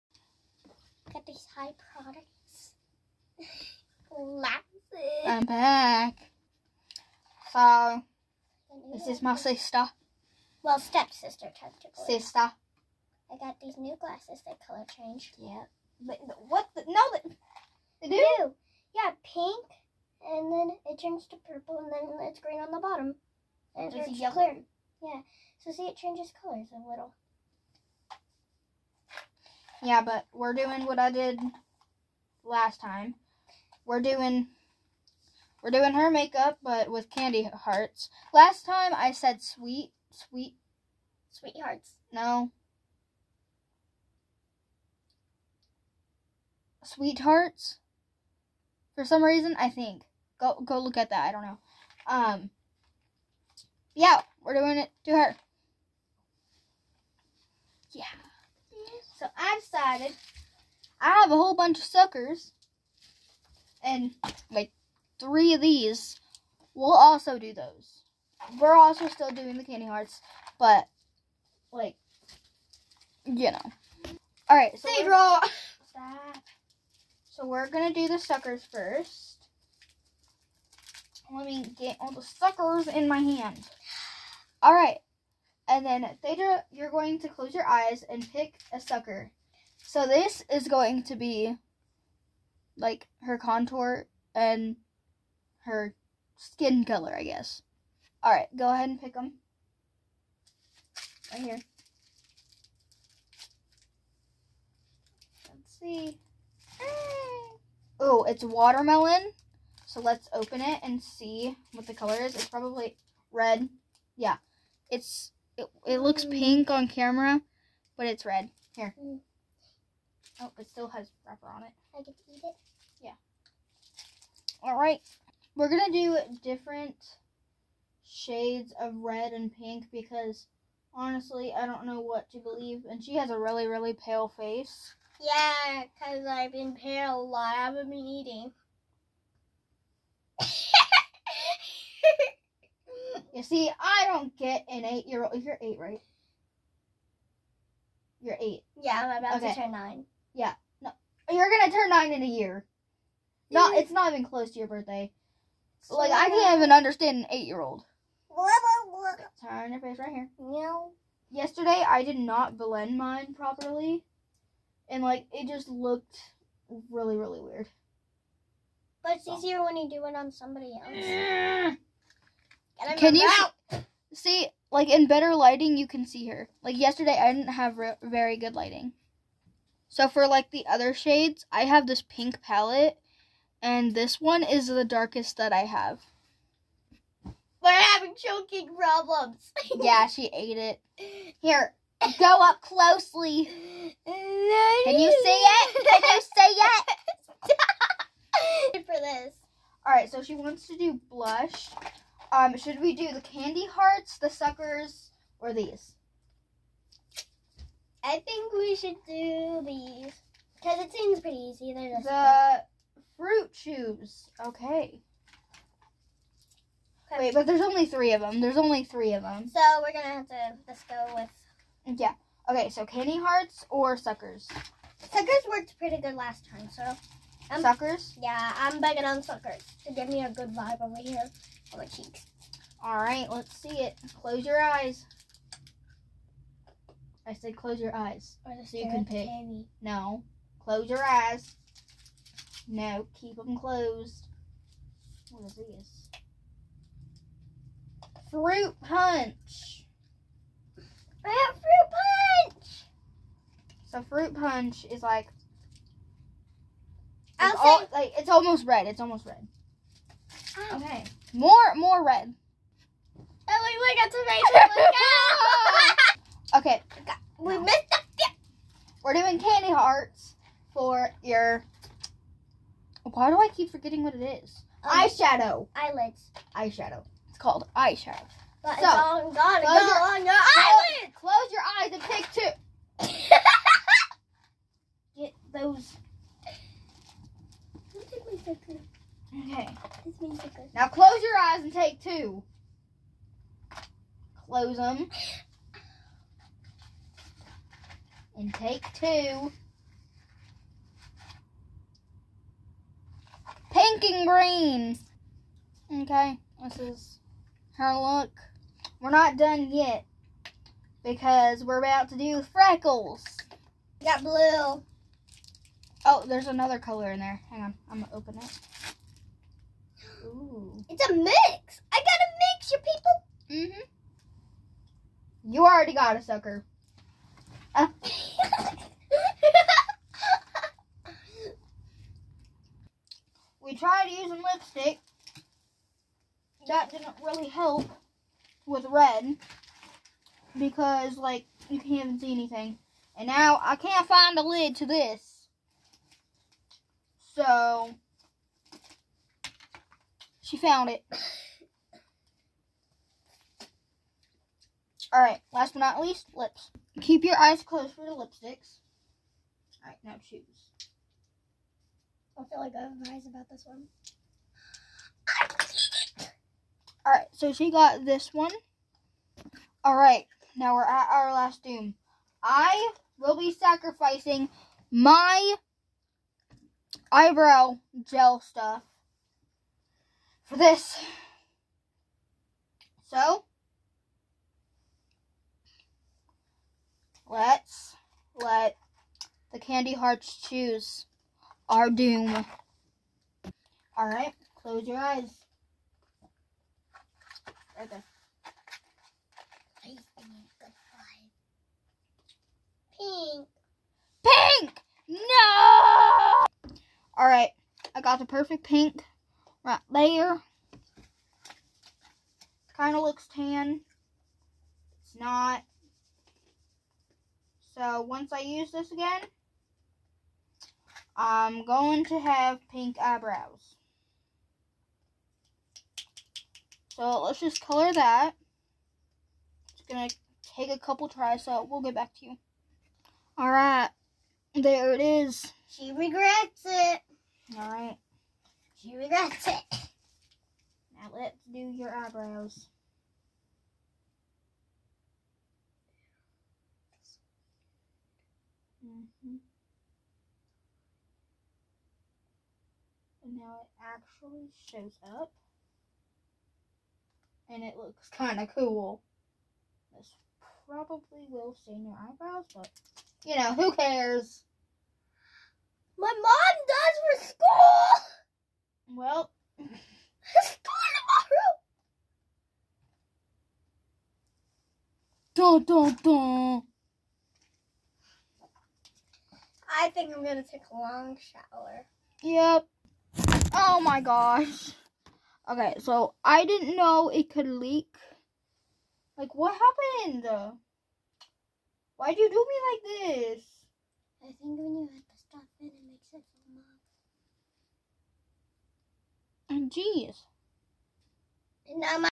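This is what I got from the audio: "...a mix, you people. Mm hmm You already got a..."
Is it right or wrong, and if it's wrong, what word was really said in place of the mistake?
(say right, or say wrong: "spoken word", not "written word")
right.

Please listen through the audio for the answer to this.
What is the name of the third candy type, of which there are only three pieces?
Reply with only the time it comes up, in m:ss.
3:33.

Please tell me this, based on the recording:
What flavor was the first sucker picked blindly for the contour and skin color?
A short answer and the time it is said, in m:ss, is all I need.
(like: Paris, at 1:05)
watermelon, at 1:48.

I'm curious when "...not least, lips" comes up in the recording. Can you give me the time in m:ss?
5:55.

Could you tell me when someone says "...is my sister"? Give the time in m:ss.
0:09.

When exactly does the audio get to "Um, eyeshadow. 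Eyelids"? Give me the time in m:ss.
4:34.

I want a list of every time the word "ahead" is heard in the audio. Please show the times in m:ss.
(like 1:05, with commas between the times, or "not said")
1:38.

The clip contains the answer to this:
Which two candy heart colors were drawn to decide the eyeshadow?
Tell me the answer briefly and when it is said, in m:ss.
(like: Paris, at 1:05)
pink and green, at 5:03.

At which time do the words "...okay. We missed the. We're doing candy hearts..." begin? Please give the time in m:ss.
4:26.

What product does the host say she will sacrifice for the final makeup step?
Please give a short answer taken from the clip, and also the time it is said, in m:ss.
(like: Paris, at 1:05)
eyebrow gel, at 6:17.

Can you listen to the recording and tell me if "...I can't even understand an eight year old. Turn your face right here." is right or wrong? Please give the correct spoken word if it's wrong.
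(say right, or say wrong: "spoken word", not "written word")
right.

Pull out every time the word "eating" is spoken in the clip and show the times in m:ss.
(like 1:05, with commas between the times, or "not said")
2:18.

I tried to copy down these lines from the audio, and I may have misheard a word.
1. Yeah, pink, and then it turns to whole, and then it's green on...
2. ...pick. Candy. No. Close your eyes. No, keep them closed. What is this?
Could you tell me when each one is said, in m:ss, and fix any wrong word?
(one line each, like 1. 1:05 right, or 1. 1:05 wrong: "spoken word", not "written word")
1. 0:18 wrong: "purple", not "whole"
2. 3:59 right.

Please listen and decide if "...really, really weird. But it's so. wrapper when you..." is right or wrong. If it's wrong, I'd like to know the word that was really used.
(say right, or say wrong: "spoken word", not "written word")
wrong: "easier", not "wrapper".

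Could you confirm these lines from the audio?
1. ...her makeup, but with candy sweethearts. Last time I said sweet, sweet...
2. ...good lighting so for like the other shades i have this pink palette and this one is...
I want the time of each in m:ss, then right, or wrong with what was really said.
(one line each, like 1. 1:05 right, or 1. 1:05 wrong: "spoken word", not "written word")
1. 0:35 wrong: "hearts", not "sweethearts"
2. 2:58 right.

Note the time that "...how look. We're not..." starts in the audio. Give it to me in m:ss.
5:07.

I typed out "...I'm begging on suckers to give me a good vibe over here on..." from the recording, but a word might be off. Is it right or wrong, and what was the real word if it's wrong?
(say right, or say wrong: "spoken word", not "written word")
right.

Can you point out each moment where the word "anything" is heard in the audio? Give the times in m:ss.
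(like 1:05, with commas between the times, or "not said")
5:42.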